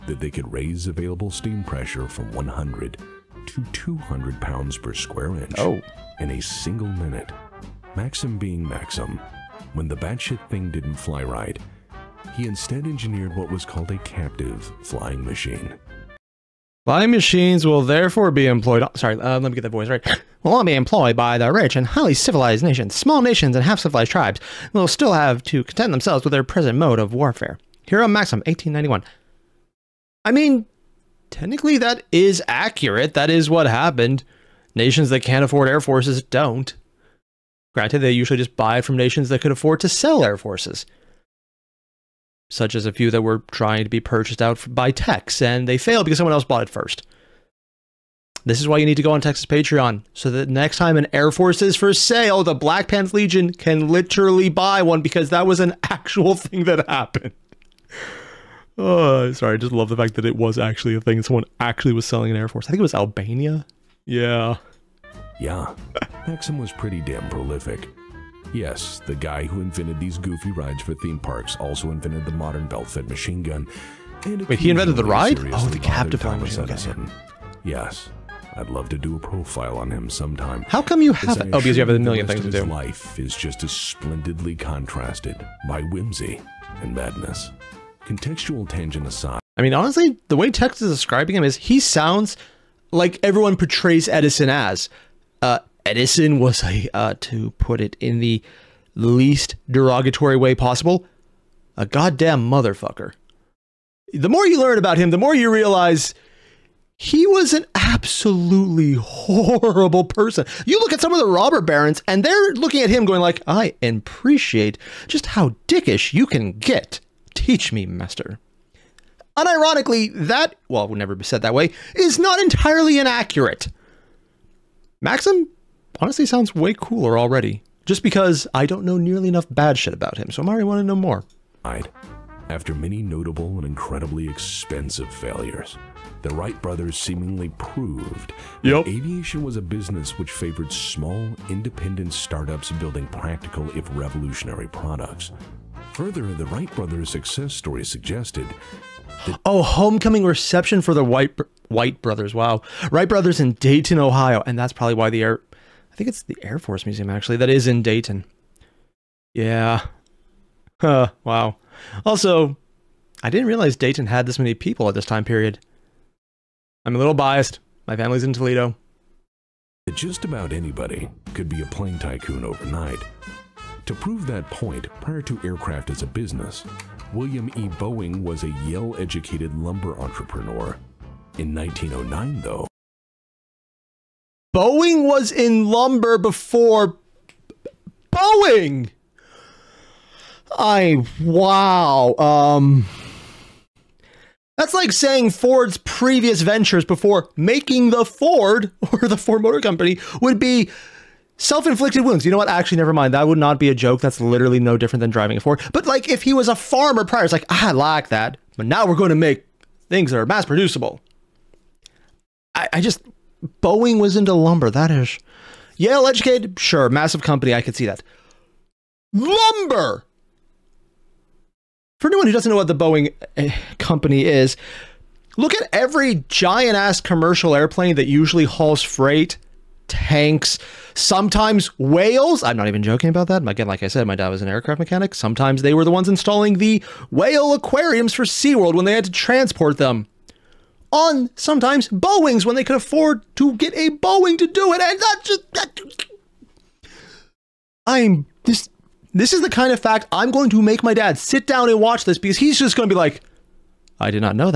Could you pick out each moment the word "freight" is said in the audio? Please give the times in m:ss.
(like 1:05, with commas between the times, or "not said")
3:48.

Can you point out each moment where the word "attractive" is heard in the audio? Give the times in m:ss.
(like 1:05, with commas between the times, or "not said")
not said.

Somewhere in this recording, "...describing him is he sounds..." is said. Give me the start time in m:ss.
1:30.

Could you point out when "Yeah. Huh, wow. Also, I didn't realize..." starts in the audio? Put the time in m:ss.
2:39.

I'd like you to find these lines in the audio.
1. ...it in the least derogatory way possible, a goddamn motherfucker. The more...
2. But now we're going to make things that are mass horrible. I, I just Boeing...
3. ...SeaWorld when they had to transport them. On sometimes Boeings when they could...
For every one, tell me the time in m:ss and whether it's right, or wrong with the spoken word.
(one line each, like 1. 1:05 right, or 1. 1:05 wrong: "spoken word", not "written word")
1. 1:37 right
2. 3:28 wrong: "producible", not "horrible"
3. 3:58 right.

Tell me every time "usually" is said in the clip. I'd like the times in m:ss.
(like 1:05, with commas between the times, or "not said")
0:38, 3:48.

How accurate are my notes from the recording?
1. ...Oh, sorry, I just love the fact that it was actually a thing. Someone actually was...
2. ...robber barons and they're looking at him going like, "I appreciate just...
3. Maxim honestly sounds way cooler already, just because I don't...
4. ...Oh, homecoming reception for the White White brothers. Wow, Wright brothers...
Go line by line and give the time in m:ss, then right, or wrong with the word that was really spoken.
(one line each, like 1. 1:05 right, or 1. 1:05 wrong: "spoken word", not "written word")
1. 0:58 right
2. 1:51 right
3. 2:04 right
4. 2:29 right.